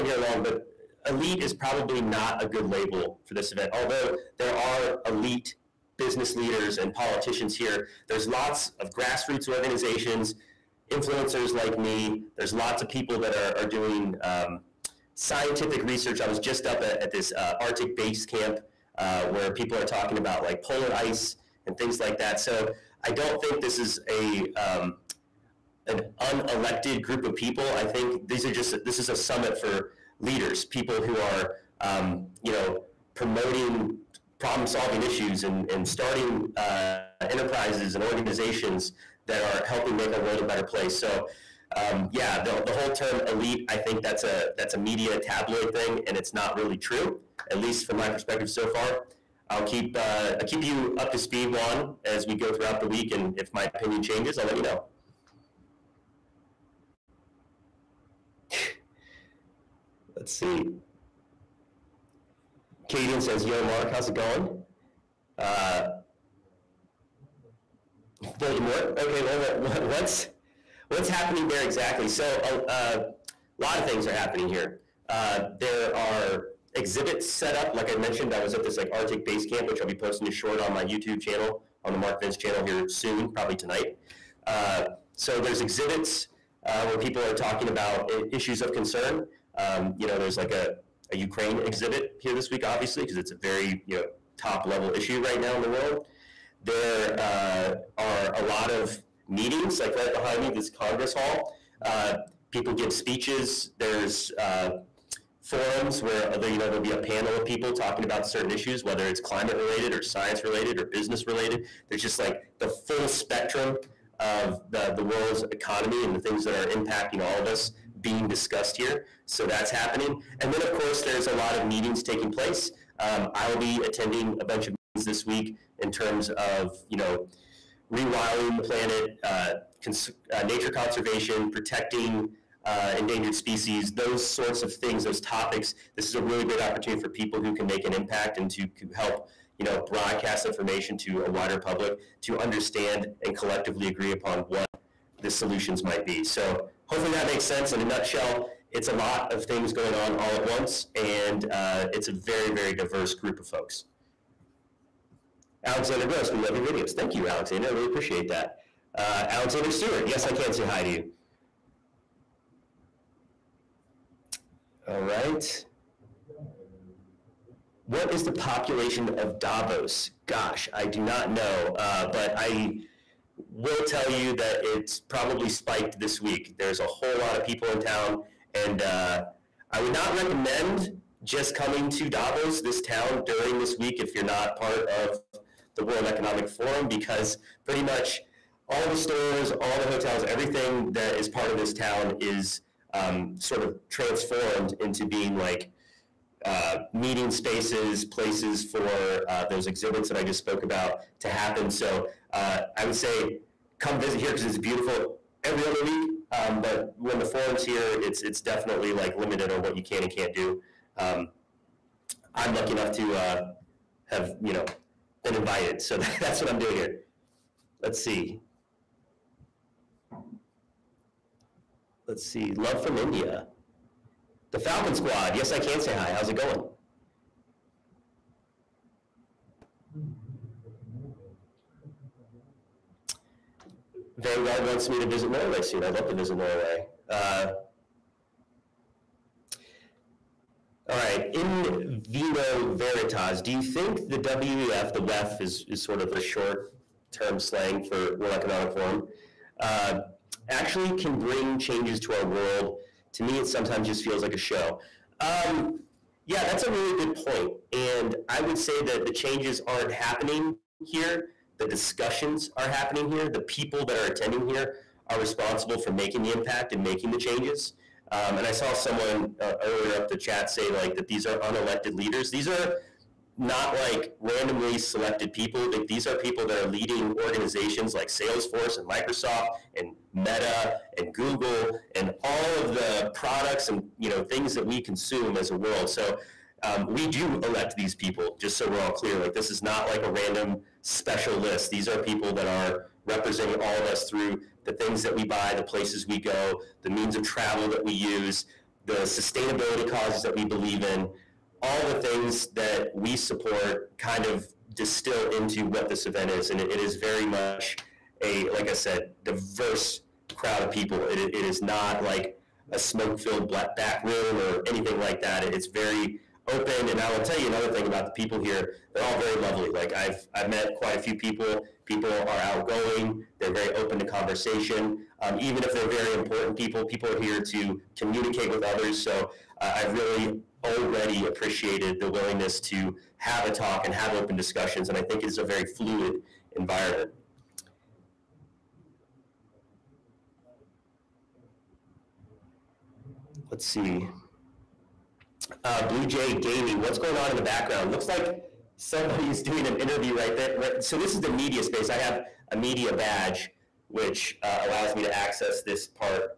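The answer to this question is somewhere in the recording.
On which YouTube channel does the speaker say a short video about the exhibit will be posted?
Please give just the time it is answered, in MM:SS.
01:21.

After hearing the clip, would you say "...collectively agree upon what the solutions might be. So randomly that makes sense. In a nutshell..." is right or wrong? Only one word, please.
wrong.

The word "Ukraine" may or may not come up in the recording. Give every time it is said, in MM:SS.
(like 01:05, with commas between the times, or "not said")
01:31.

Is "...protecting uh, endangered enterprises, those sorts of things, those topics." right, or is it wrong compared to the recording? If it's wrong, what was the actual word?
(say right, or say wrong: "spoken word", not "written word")
wrong: "species", not "enterprises".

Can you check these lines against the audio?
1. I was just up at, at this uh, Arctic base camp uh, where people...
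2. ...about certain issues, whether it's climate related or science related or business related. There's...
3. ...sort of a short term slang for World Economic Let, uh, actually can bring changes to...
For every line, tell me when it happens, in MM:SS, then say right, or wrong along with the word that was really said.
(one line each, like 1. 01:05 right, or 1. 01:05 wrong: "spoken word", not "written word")
1. 00:16 right
2. 01:48 right
3. 04:05 wrong: "Forum", not "Let".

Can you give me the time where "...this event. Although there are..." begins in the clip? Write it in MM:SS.
00:03.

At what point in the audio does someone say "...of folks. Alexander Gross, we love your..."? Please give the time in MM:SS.
02:33.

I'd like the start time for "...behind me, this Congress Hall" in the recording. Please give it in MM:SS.
01:40.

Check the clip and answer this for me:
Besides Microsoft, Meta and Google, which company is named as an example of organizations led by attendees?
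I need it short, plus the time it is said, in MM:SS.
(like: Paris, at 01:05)
Salesforce, at 04:38.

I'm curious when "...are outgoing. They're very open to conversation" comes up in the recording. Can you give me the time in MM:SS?
05:22.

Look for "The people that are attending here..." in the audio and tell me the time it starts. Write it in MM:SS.
04:23.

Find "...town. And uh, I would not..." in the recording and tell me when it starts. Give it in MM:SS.
02:57.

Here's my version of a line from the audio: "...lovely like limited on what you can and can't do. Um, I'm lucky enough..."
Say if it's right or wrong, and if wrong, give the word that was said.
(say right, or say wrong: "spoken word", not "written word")
wrong: "definitely", not "lovely".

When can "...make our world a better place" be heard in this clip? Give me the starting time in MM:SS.
00:39.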